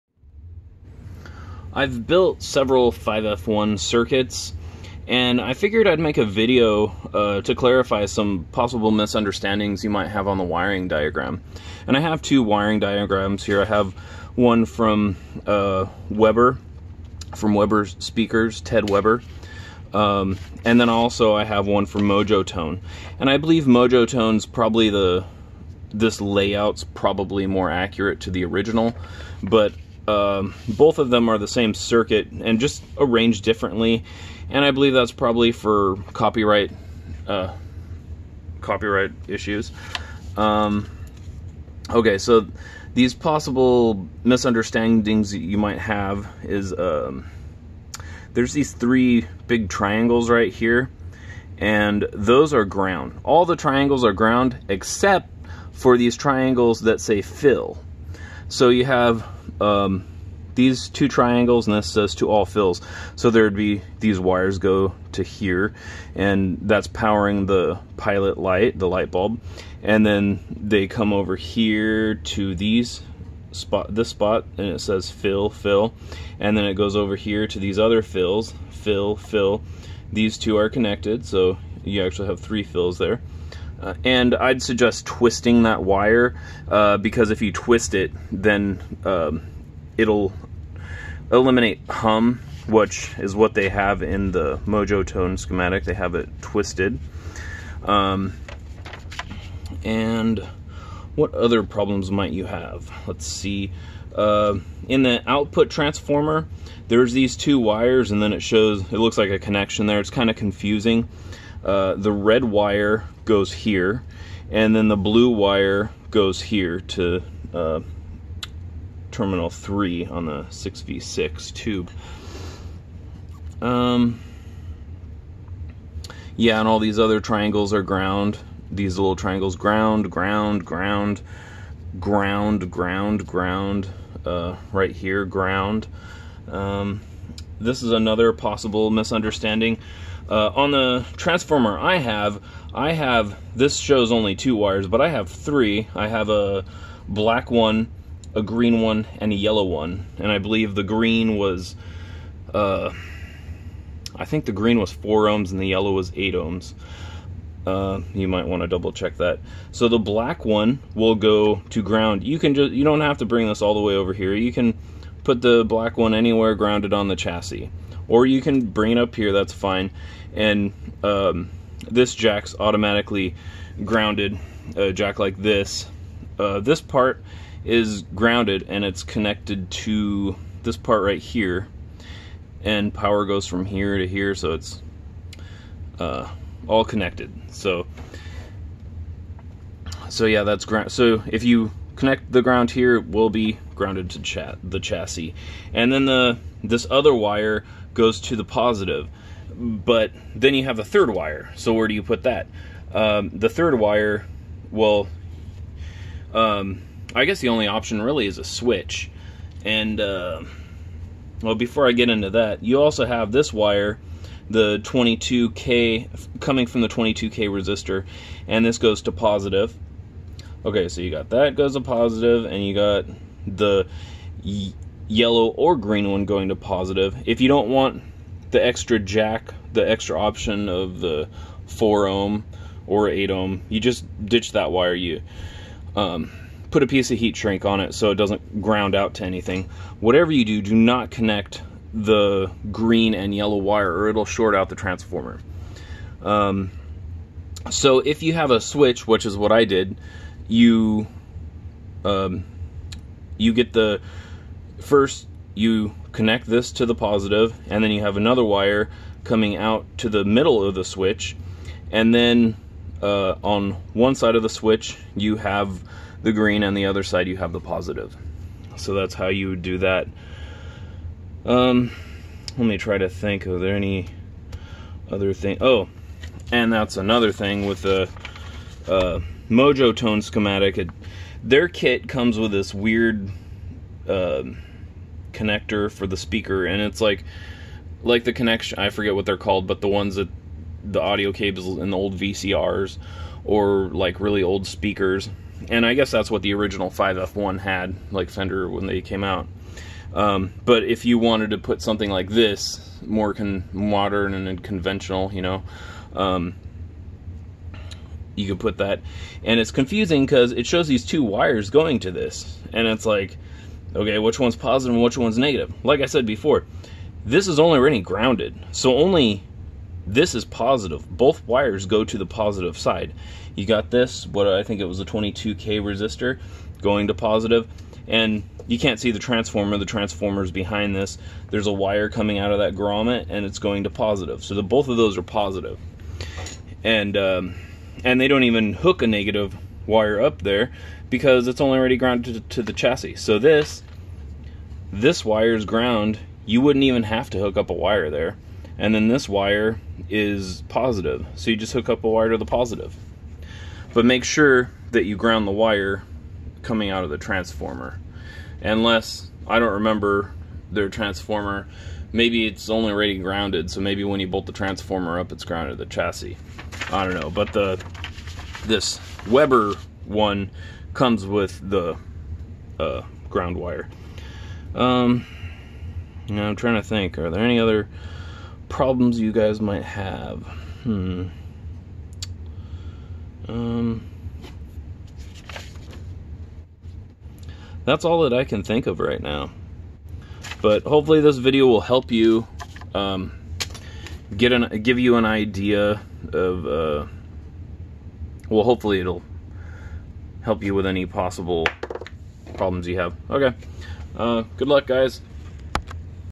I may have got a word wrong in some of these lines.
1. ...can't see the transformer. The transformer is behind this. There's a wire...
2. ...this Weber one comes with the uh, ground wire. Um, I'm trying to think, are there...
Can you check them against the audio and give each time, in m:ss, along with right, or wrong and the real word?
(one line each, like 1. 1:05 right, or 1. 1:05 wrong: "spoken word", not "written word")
1. 5:28 right
2. 6:08 right.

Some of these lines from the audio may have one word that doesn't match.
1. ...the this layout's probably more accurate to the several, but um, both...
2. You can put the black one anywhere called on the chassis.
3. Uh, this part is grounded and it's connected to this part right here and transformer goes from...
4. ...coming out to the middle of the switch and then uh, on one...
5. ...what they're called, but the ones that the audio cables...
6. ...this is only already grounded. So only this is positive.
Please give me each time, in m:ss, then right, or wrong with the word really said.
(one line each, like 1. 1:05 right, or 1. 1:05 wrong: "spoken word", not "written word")
1. 0:24 wrong: "original", not "several"
2. 2:44 wrong: "grounded", not "called"
3. 2:56 wrong: "power", not "transformer"
4. 4:19 right
5. 4:49 right
6. 5:17 right.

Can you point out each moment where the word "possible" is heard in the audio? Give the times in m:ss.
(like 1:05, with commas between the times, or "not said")
0:08, 0:43, 2:18, 6:41.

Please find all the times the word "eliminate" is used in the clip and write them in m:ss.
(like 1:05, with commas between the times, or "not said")
1:31.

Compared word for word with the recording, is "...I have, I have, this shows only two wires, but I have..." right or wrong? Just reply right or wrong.
right.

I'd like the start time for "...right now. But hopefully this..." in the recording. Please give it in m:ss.
6:28.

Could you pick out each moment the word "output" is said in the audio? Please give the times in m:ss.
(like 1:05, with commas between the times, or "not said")
1:45.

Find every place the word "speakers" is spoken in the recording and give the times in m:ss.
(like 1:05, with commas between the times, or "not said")
0:17, 4:46, 4:54.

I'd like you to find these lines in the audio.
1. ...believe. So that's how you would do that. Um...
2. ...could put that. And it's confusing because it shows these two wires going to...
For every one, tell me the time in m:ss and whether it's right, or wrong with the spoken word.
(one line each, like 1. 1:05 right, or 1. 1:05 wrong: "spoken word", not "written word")
1. 4:27 wrong: "positive", not "believe"
2. 5:08 right.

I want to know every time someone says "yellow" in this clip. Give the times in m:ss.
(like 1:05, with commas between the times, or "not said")
2:29, 2:35, 3:45, 4:03.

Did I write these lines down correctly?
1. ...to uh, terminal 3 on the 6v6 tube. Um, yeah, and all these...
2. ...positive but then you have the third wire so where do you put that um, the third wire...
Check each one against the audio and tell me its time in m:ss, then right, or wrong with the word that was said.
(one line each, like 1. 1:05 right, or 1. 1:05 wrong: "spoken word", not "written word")
1. 1:56 right
2. 3:18 right.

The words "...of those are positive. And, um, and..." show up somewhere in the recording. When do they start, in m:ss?
5:34.